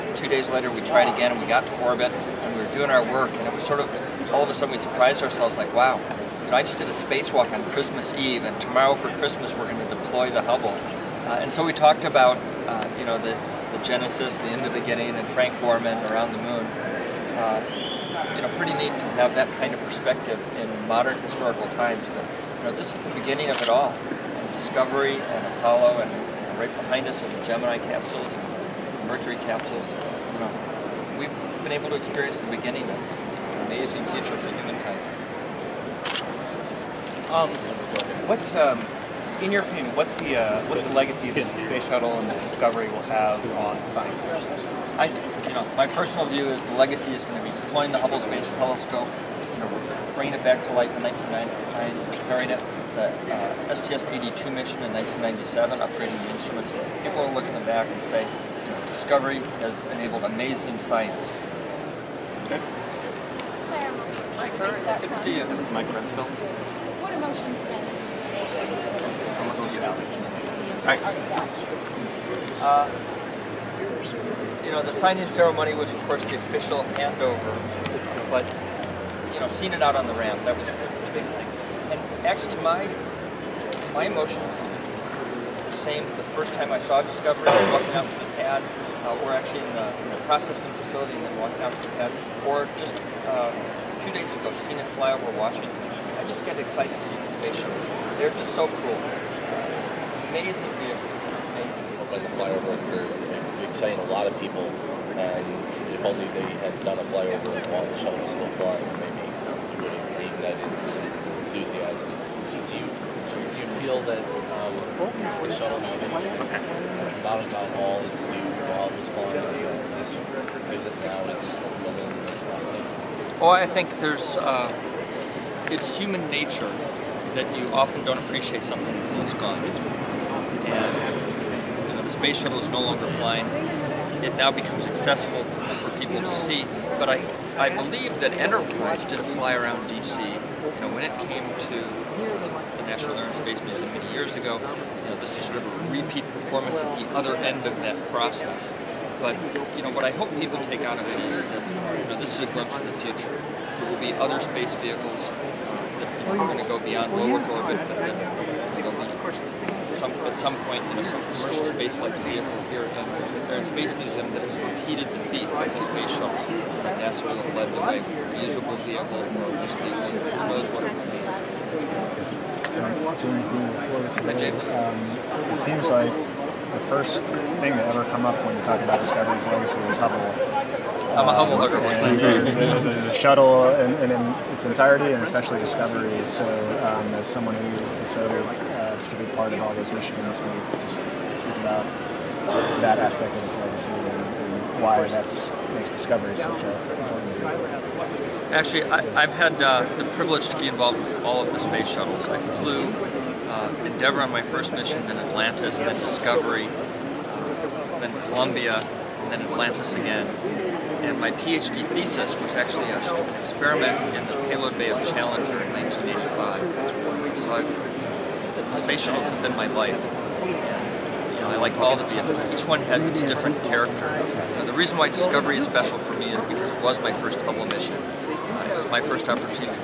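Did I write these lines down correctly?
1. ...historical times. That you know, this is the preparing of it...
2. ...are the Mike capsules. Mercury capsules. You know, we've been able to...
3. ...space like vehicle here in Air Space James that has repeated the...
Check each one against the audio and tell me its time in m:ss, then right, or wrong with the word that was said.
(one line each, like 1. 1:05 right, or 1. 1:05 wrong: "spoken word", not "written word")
1. 0:21 wrong: "beginning", not "preparing"
2. 0:27 wrong: "Gemini", not "Mike"
3. 2:41 wrong: "Museum", not "James".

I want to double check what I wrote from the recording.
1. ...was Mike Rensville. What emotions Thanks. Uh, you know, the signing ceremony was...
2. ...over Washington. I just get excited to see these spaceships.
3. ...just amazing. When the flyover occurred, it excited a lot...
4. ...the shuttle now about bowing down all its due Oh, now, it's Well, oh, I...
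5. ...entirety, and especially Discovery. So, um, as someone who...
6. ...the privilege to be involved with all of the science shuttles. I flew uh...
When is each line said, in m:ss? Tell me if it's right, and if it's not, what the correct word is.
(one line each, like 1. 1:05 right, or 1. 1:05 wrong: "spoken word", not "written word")
1. 1:05 right
2. 1:35 right
3. 1:41 right
4. 1:55 right
5. 3:04 right
6. 3:19 wrong: "space", not "science".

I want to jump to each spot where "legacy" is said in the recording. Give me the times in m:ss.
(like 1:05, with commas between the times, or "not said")
0:40, 0:46, 2:59, 3:13.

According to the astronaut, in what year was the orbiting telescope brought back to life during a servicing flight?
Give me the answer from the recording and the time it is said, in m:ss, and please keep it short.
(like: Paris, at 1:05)
1999, at 0:51.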